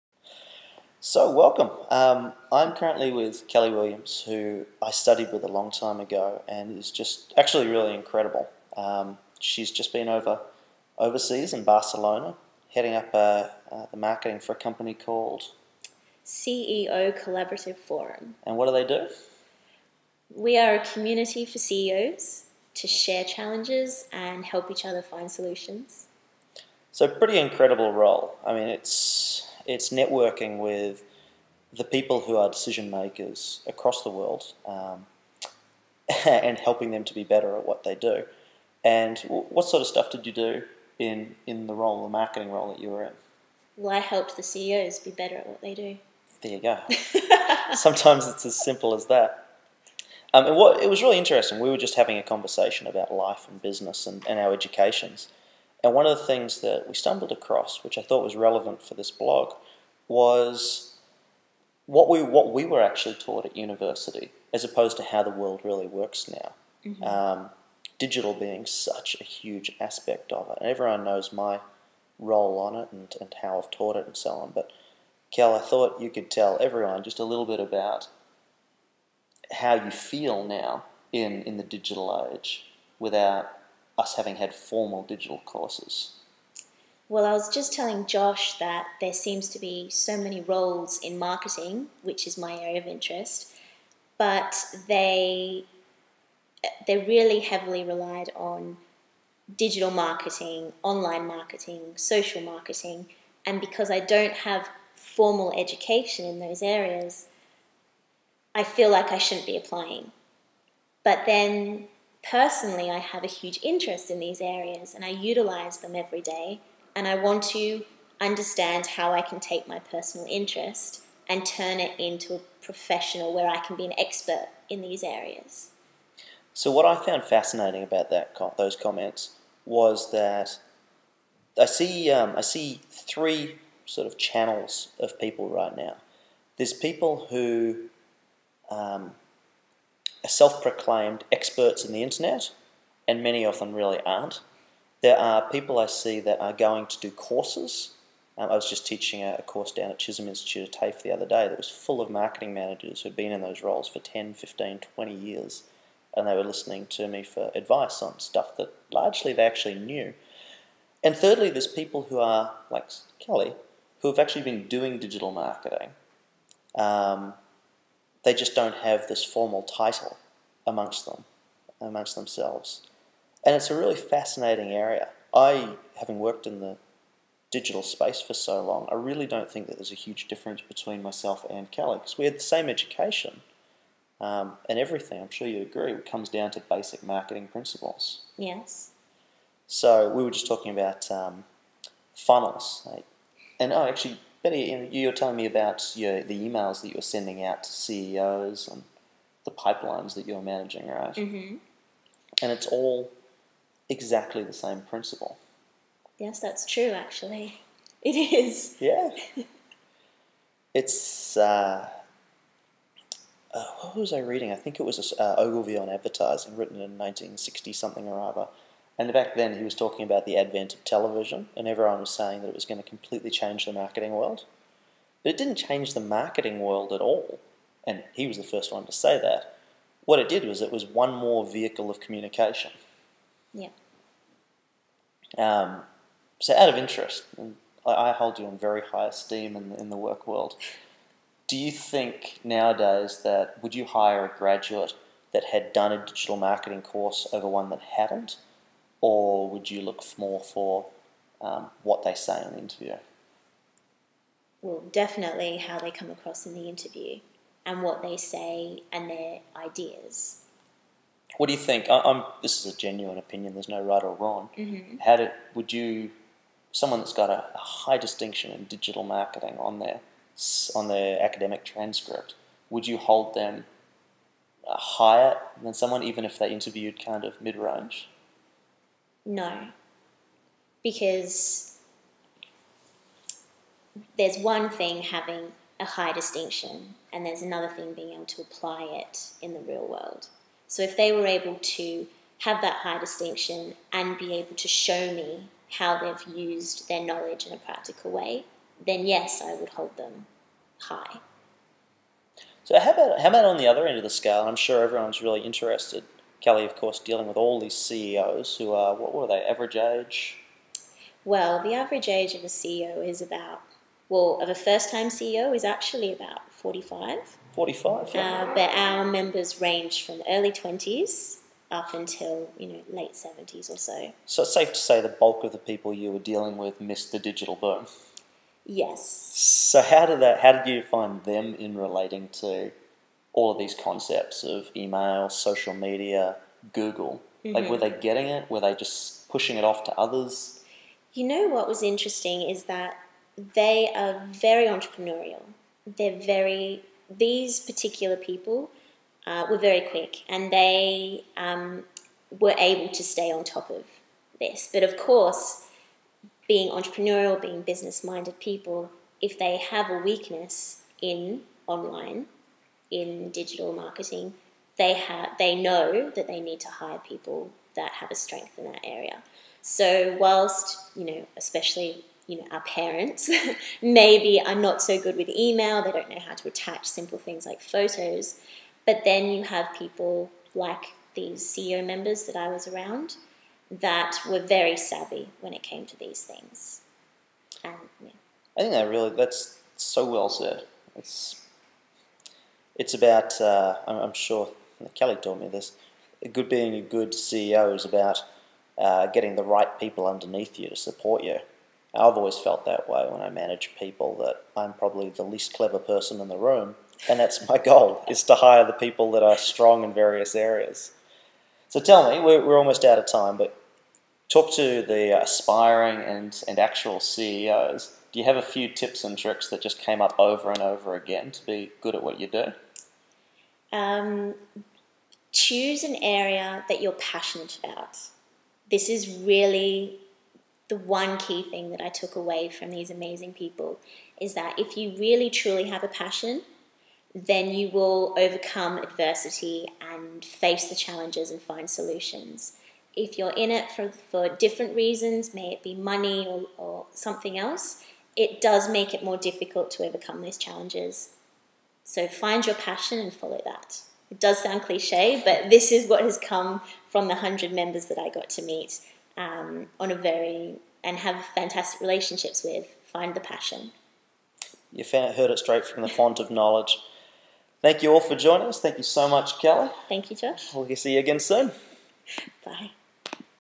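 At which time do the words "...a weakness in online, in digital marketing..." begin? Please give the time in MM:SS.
05:59.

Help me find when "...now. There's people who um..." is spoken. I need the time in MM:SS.
02:15.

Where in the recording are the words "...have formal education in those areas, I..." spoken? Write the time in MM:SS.
01:44.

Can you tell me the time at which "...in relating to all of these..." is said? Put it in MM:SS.
05:31.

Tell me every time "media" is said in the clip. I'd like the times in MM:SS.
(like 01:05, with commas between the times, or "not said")
05:35.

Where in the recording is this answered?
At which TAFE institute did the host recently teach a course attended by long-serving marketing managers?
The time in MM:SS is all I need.
02:29.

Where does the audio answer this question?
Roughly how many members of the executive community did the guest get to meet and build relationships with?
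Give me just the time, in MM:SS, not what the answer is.
07:37.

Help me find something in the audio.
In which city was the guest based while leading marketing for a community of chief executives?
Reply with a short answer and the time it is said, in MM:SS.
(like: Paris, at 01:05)
Barcelona, at 00:11.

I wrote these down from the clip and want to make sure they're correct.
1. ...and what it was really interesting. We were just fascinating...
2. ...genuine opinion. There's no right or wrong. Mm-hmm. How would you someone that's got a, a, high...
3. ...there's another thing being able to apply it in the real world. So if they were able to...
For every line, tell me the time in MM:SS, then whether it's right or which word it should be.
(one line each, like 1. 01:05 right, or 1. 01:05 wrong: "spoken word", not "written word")
1. 00:50 wrong: "having", not "fascinating"
2. 04:22 right
3. 04:47 right.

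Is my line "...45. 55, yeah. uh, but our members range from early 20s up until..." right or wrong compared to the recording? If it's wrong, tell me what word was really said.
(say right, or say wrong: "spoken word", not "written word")
wrong: "45", not "55".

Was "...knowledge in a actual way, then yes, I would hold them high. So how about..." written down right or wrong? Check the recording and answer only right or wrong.
wrong.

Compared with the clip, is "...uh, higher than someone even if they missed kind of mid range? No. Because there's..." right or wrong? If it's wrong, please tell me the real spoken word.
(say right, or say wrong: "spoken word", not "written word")
wrong: "interviewed", not "missed".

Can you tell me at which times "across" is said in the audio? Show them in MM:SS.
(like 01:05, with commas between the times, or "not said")
00:33, 00:57, 04:16.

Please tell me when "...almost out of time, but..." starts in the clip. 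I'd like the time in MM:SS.
06:52.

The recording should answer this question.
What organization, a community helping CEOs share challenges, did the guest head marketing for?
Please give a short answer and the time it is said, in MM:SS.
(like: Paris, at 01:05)
CEO Collaborative Forum, at 00:16.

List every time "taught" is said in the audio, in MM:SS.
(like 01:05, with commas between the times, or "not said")
01:03, 01:13.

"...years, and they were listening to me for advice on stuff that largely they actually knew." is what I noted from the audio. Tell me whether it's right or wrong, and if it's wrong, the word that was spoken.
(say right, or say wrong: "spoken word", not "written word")
right.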